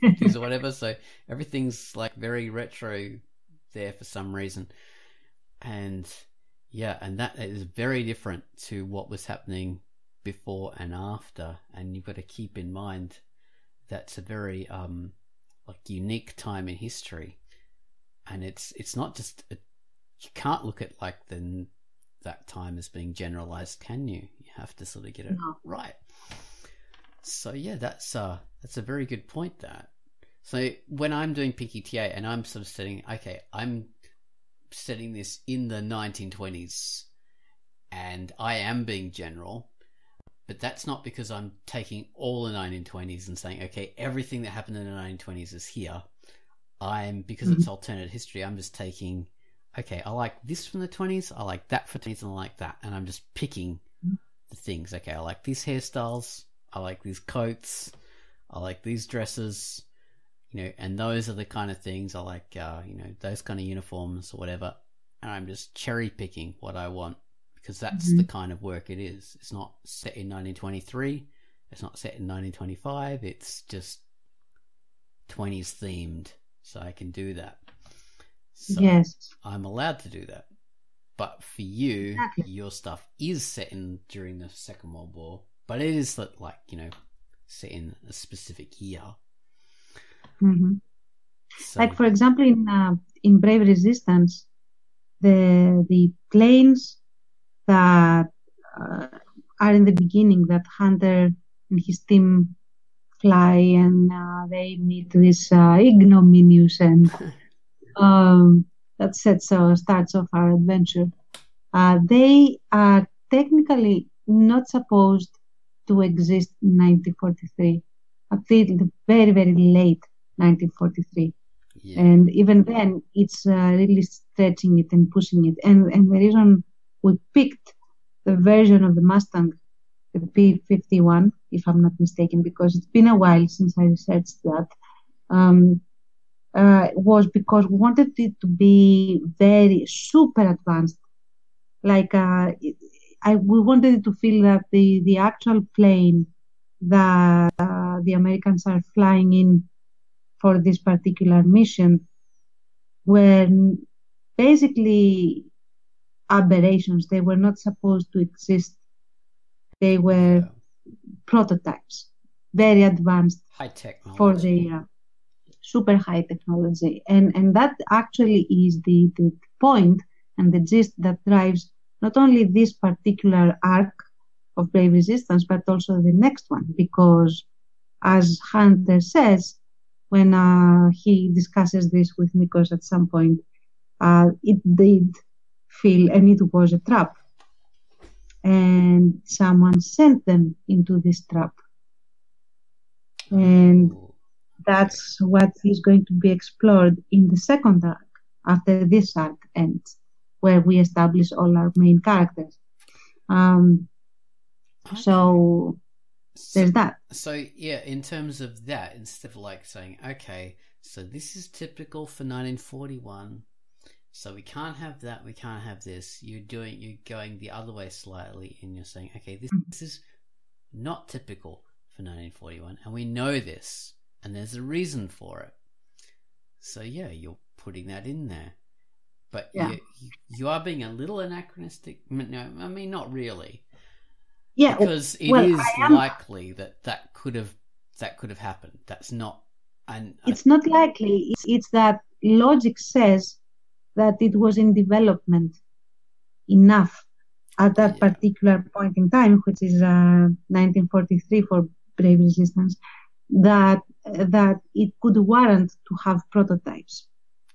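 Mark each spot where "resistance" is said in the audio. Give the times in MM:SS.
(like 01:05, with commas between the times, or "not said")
01:33, 02:54, 04:12.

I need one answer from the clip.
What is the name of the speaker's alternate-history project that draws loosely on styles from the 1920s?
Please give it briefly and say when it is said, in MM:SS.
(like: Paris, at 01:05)
Pinky TA, at 00:31.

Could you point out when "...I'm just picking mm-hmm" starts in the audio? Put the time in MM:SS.
00:52.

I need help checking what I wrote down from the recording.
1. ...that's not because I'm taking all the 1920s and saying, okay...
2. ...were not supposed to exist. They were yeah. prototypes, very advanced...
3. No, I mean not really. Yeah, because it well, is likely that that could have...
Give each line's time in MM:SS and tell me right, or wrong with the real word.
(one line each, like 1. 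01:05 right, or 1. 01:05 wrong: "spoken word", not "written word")
1. 00:40 right
2. 02:37 right
3. 03:52 right.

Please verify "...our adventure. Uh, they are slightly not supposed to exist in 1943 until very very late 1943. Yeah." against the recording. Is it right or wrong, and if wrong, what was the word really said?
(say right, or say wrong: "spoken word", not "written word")
wrong: "technically", not "slightly".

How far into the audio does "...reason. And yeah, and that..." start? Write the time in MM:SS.
00:04.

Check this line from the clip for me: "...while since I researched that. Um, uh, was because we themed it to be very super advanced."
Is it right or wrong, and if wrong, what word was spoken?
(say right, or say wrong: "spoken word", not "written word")
wrong: "wanted", not "themed".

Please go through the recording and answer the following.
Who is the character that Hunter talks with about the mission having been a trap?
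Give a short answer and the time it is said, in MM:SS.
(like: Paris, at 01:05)
Nikos, at 03:02.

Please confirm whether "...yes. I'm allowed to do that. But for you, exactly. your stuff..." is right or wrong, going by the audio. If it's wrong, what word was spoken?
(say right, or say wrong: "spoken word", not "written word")
right.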